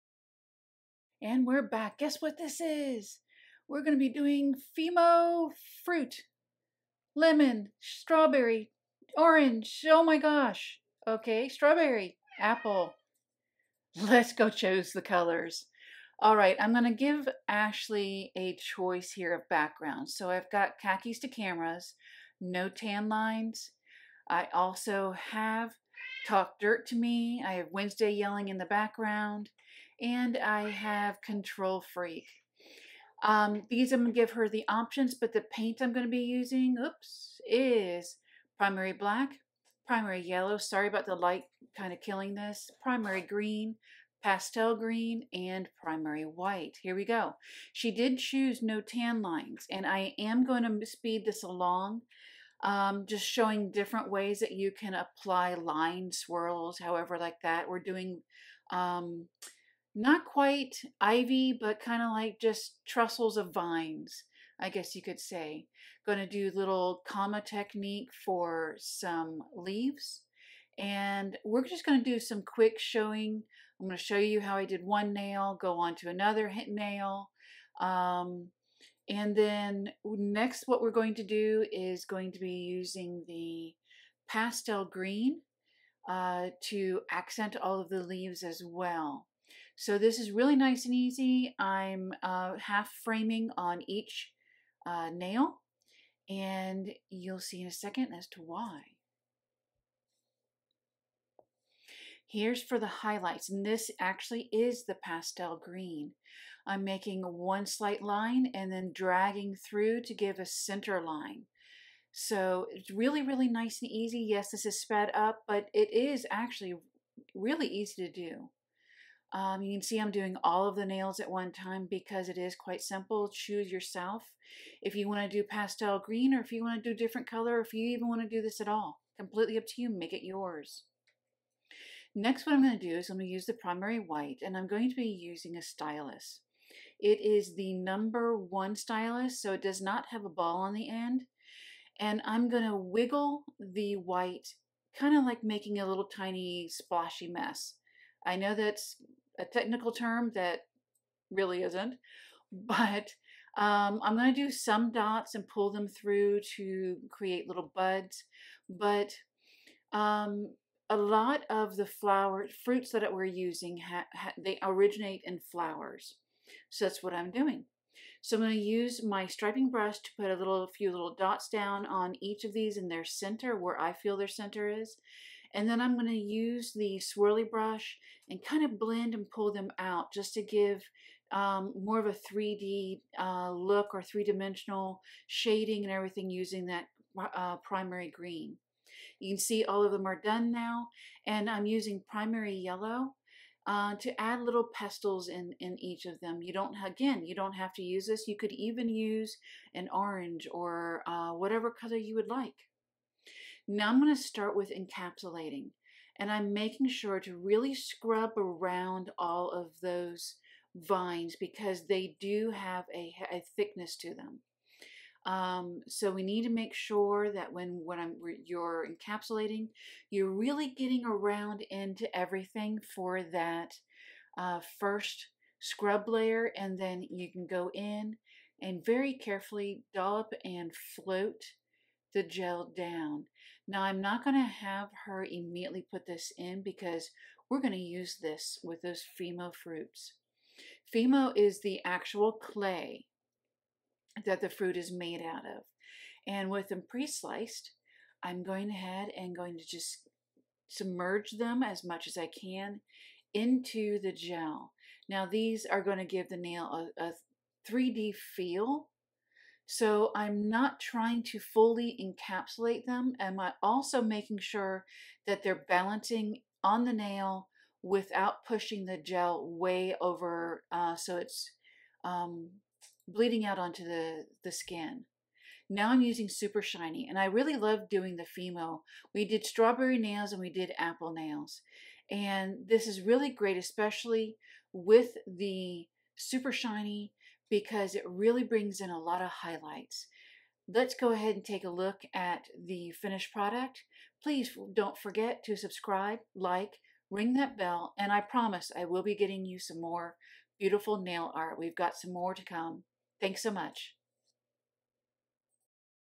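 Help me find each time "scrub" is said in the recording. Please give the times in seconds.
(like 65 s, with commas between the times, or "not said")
207 s, 225 s.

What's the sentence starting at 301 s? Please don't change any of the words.
We've got some more to come.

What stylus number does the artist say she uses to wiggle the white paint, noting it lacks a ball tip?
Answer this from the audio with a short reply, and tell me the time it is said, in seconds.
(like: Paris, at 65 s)
1, at 137 s.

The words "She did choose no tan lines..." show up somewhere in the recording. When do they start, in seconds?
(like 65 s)
47 s.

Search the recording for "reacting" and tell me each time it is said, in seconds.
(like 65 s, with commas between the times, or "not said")
not said.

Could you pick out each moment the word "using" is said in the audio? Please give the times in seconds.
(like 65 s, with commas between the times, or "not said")
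36 s, 82 s, 135 s, 163 s, 186 s, 191 s, 276 s.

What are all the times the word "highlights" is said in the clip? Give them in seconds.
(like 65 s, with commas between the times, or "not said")
102 s, 289 s.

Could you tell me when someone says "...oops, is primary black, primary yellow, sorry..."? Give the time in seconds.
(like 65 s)
36 s.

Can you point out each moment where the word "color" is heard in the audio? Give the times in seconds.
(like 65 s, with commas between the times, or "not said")
15 s, 127 s, 201 s.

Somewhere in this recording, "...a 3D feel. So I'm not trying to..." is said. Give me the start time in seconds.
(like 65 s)
257 s.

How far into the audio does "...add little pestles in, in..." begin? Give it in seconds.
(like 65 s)
194 s.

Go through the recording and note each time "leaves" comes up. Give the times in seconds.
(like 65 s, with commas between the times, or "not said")
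69 s, 88 s.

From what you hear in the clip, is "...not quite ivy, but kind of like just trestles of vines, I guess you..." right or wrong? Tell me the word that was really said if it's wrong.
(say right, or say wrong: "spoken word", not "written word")
right.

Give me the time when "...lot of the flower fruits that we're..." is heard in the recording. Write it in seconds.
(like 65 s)
160 s.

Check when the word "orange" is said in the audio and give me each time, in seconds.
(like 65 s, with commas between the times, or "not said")
9 s, 199 s.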